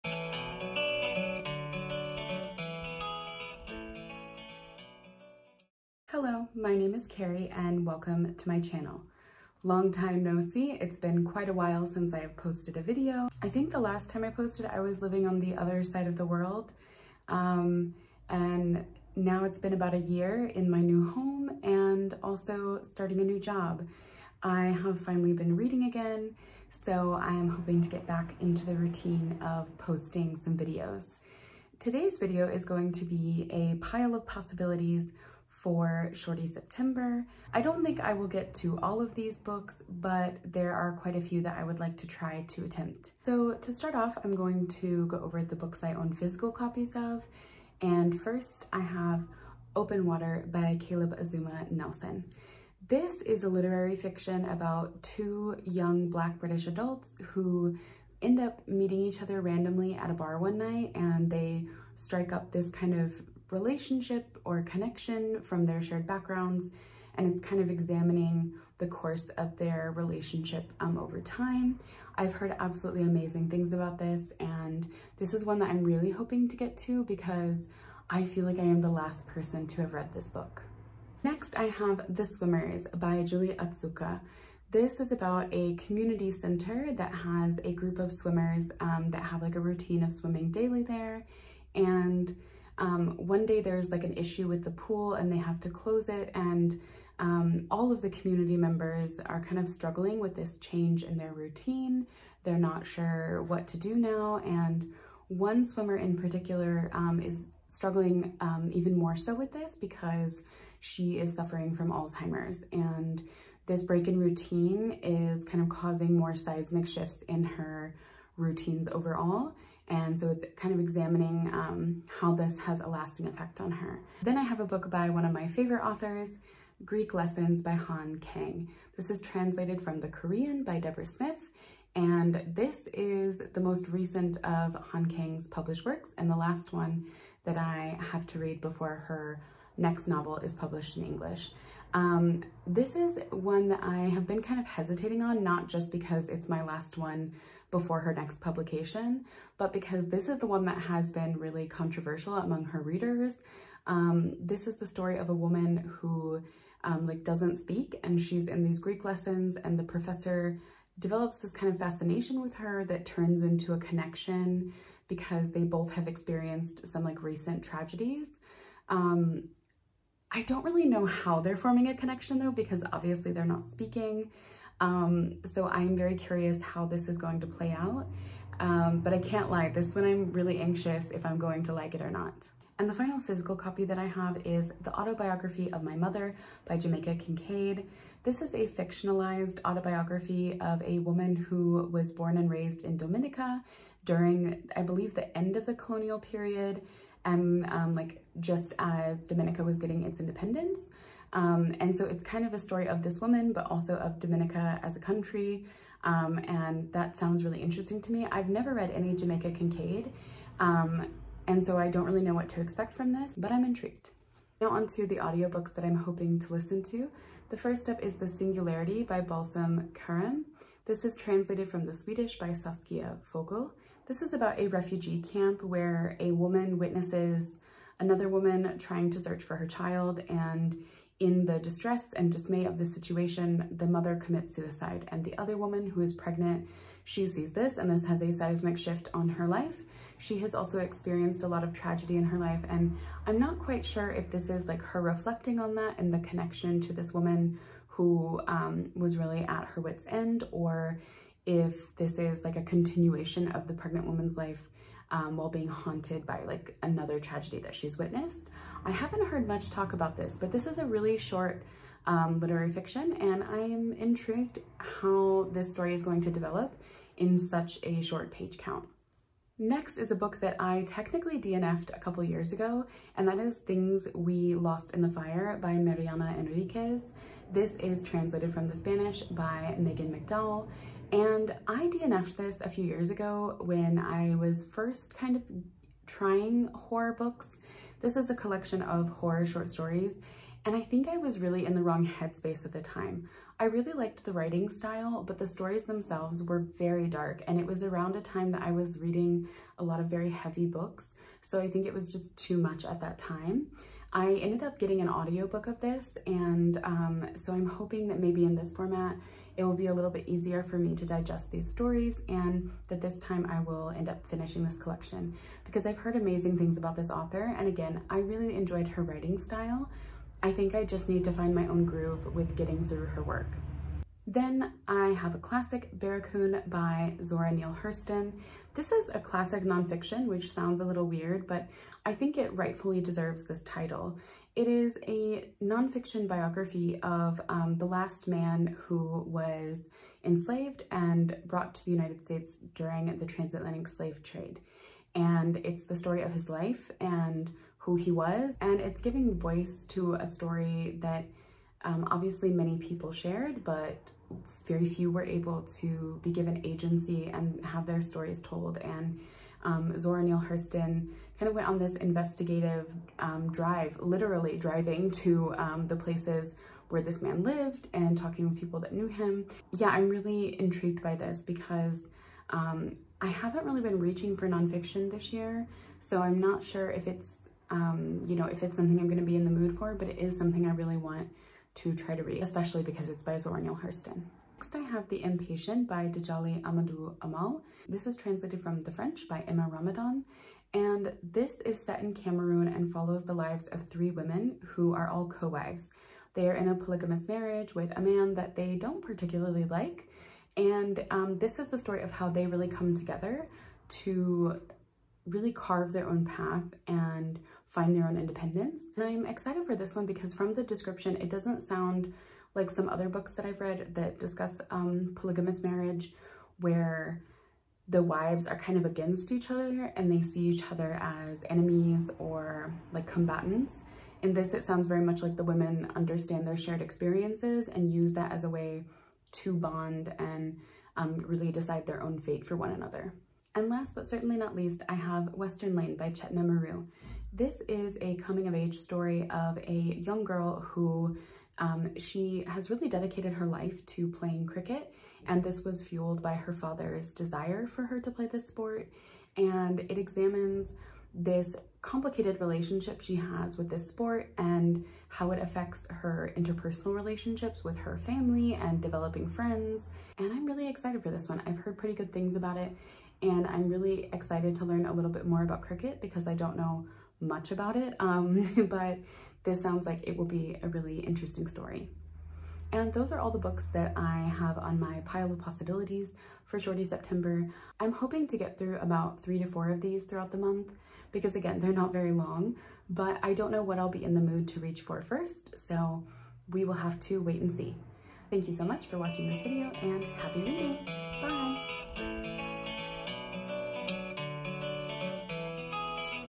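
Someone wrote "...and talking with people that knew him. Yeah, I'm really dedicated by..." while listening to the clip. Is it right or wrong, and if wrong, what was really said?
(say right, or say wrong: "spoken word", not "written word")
wrong: "intrigued", not "dedicated".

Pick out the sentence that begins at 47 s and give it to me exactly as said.
And first I have Open Water by Caleb Azumah Nelson.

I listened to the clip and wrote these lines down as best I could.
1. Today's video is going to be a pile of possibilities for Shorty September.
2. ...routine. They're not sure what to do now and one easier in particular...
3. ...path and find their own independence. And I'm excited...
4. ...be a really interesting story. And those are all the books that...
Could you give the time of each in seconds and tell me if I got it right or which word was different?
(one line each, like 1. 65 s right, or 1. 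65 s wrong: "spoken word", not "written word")
1. 31 s right
2. 101 s wrong: "swimmer", not "easier"
3. 406 s right
4. 470 s right.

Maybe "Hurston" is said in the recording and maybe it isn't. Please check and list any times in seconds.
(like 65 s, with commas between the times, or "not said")
327 s, 360 s, 383 s.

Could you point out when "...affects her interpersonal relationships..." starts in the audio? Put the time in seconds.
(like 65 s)
455 s.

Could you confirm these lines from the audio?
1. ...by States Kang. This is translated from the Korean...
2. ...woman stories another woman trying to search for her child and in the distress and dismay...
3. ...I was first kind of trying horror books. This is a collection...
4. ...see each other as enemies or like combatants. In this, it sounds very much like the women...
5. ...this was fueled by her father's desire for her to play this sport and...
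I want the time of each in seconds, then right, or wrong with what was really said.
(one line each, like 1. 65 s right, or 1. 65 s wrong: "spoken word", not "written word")
1. 127 s wrong: "Han", not "States"
2. 226 s wrong: "witnesses", not "stories"
3. 283 s right
4. 420 s right
5. 445 s right.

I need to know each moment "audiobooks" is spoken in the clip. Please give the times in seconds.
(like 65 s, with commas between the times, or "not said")
215 s, 305 s.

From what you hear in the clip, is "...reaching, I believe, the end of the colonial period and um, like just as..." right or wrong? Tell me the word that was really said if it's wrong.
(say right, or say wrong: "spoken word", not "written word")
wrong: "during", not "reaching".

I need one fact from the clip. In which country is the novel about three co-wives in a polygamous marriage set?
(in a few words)
Cameroon.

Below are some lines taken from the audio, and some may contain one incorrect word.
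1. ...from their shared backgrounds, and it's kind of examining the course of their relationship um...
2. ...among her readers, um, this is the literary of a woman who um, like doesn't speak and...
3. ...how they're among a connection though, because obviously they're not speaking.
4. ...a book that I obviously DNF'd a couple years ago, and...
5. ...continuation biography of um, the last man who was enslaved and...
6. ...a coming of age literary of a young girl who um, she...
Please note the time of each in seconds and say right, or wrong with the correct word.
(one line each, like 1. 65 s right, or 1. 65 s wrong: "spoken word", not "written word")
1. 65 s right
2. 152 s wrong: "story", not "literary"
3. 171 s wrong: "forming", not "among"
4. 270 s wrong: "technically", not "obviously"
5. 335 s wrong: "nonfiction", not "continuation"
6. 437 s wrong: "story", not "literary".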